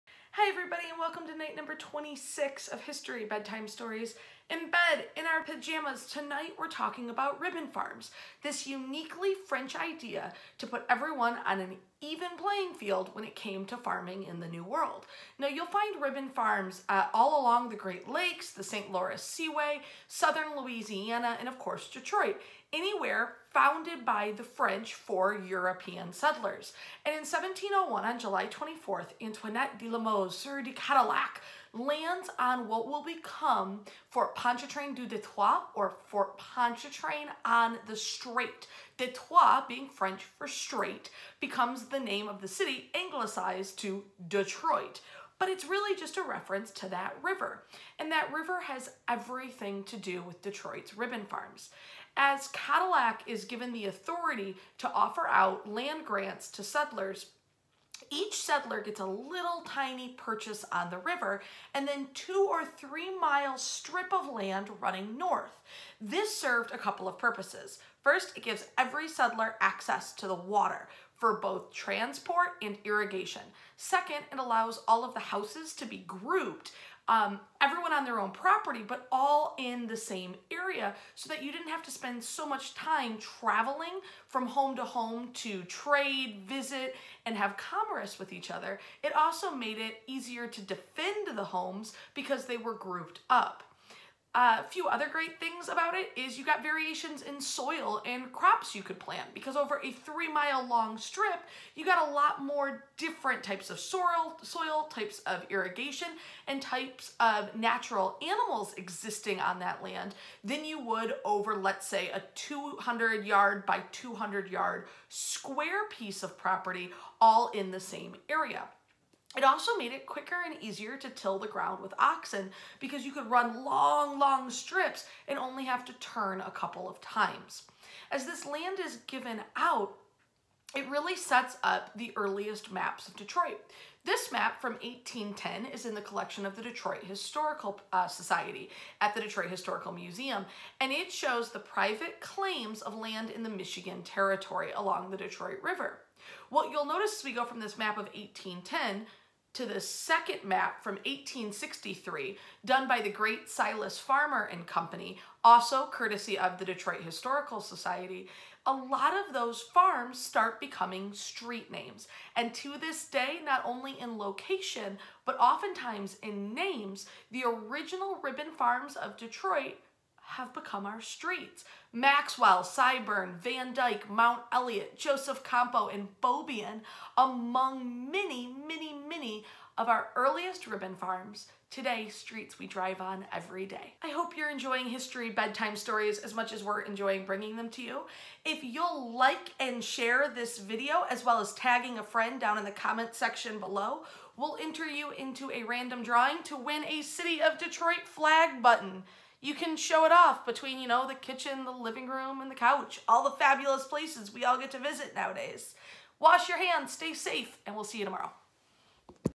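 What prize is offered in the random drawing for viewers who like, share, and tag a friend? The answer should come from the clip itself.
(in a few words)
City of Detroit flag button.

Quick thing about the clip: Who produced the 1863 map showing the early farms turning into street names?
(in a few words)
Silas Farmer and Company.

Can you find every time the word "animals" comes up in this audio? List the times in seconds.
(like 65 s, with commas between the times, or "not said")
108 s.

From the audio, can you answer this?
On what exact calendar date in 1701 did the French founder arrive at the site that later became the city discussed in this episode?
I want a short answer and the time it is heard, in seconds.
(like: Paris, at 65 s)
July 24th, at 28 s.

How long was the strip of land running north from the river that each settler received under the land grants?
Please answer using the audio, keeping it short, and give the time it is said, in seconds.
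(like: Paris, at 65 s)
two or three mile, at 62 s.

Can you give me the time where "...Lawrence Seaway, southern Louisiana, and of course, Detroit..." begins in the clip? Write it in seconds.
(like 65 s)
18 s.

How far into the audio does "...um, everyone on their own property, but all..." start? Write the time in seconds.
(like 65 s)
77 s.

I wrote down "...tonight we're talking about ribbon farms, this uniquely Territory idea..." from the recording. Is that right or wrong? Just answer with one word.
wrong.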